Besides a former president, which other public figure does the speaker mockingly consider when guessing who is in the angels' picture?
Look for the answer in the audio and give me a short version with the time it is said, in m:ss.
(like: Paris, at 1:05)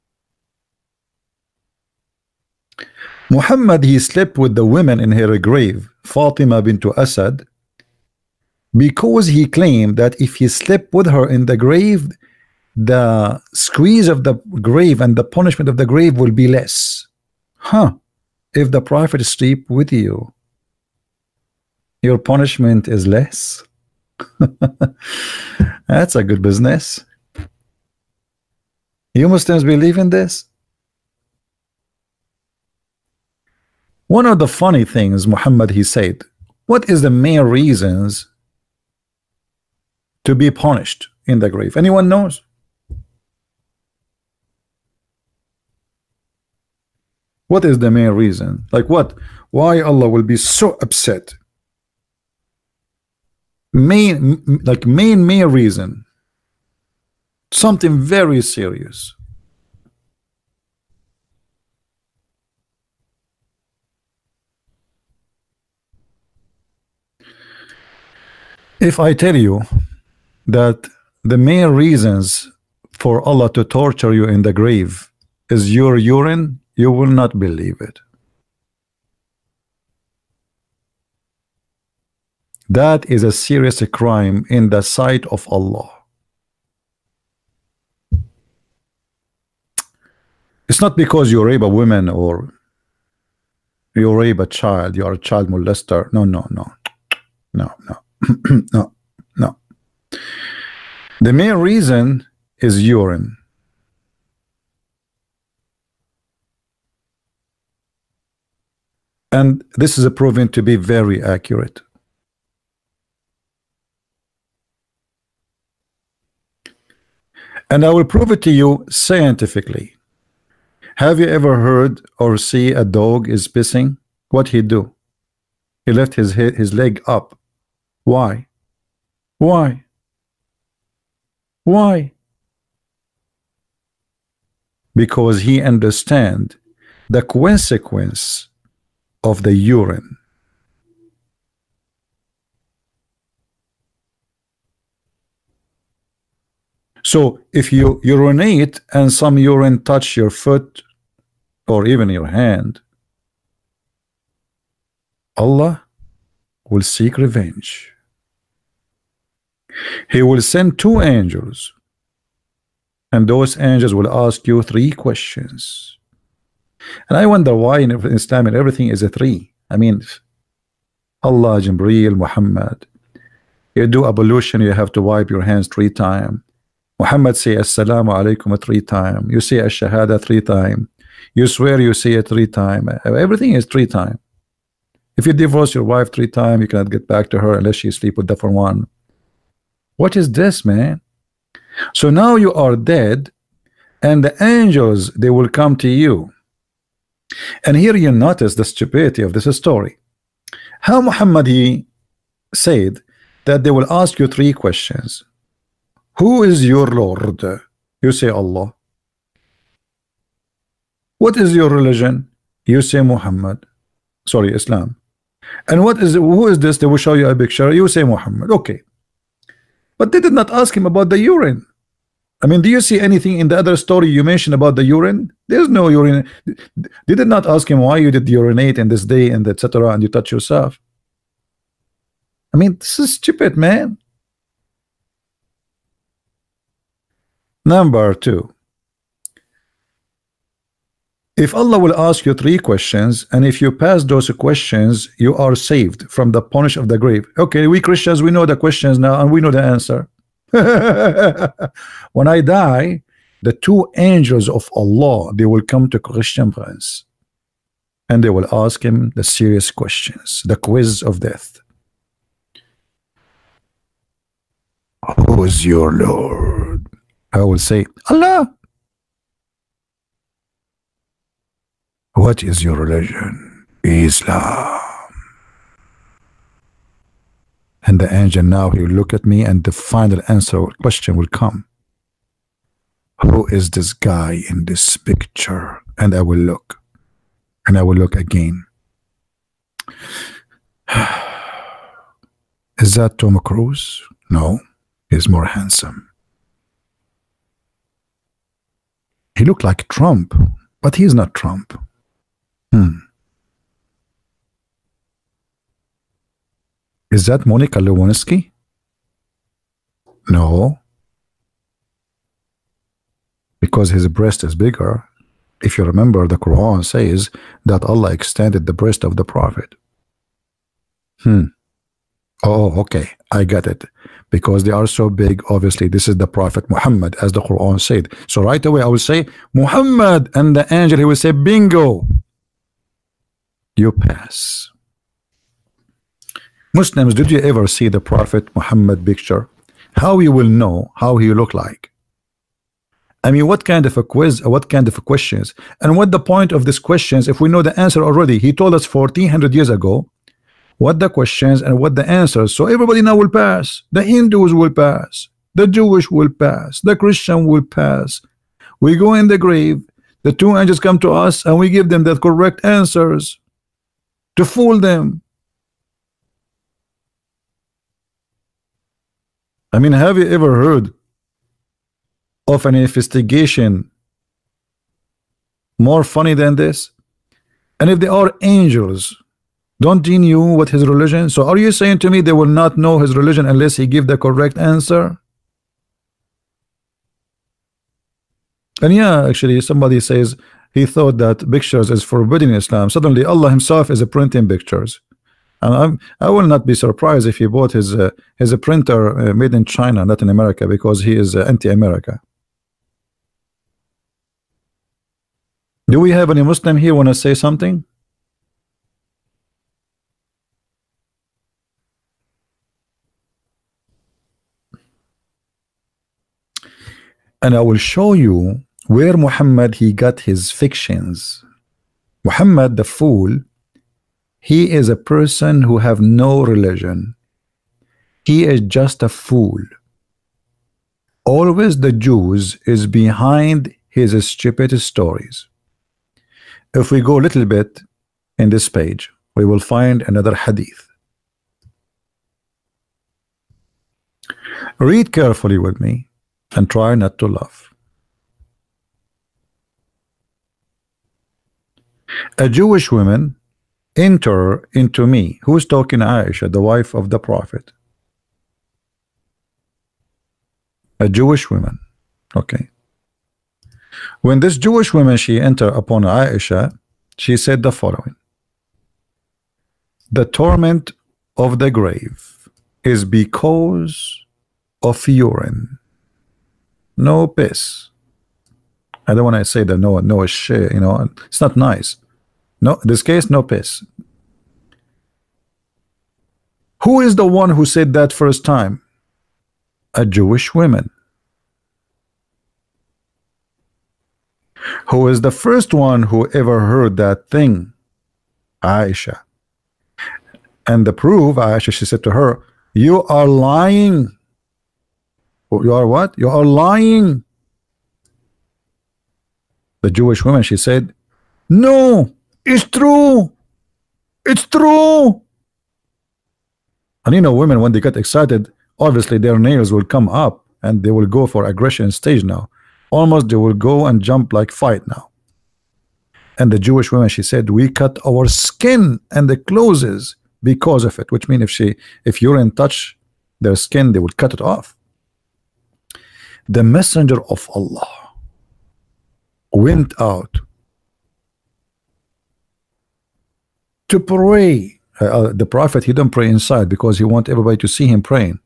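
Monica Lewinsky, at 5:07.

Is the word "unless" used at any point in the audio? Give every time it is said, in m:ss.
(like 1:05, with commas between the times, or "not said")
3:07, 6:23.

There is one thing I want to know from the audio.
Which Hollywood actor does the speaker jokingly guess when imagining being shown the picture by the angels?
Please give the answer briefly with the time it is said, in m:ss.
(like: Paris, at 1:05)
Tom Cruise, at 4:53.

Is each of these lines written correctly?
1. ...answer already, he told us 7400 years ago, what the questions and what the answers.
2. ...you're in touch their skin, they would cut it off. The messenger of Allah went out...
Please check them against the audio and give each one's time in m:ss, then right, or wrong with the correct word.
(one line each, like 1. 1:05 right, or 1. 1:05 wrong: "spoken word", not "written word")
1. 5:47 wrong: "1400", not "7400"
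2. 8:52 right.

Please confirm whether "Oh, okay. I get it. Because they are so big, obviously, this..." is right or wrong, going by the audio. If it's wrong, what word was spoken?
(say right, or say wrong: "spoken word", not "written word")
right.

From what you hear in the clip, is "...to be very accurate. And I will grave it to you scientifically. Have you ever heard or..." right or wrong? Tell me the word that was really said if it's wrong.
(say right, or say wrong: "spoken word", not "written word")
wrong: "prove", not "grave".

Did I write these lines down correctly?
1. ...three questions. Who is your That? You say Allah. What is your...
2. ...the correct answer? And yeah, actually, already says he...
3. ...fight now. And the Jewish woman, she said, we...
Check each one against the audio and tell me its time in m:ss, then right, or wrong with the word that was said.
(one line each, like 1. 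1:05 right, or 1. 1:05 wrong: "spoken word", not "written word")
1. 3:24 wrong: "Lord", not "That"
2. 6:24 wrong: "somebody", not "already"
3. 8:44 right.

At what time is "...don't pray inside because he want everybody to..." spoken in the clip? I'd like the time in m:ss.
9:05.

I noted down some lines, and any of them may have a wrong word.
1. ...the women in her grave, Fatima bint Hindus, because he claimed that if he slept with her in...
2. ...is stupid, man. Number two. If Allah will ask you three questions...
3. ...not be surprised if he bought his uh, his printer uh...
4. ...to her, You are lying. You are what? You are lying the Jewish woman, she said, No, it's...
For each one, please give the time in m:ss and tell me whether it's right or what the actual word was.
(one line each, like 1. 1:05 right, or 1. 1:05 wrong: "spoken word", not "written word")
1. 0:04 wrong: "Asad", not "Hindus"
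2. 3:52 right
3. 6:36 right
4. 8:22 right.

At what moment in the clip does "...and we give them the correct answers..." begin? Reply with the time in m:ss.
6:01.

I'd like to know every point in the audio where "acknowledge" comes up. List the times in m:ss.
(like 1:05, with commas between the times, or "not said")
not said.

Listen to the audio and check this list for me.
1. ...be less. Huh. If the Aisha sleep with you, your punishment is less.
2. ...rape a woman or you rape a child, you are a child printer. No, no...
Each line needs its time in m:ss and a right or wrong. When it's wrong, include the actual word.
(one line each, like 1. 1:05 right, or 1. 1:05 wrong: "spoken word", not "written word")
1. 0:16 wrong: "Prophet", not "Aisha"
2. 1:31 wrong: "molester", not "printer".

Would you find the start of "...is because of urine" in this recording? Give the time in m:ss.
7:52.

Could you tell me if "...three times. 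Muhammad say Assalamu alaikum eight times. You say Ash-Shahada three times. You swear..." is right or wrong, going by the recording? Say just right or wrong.
wrong.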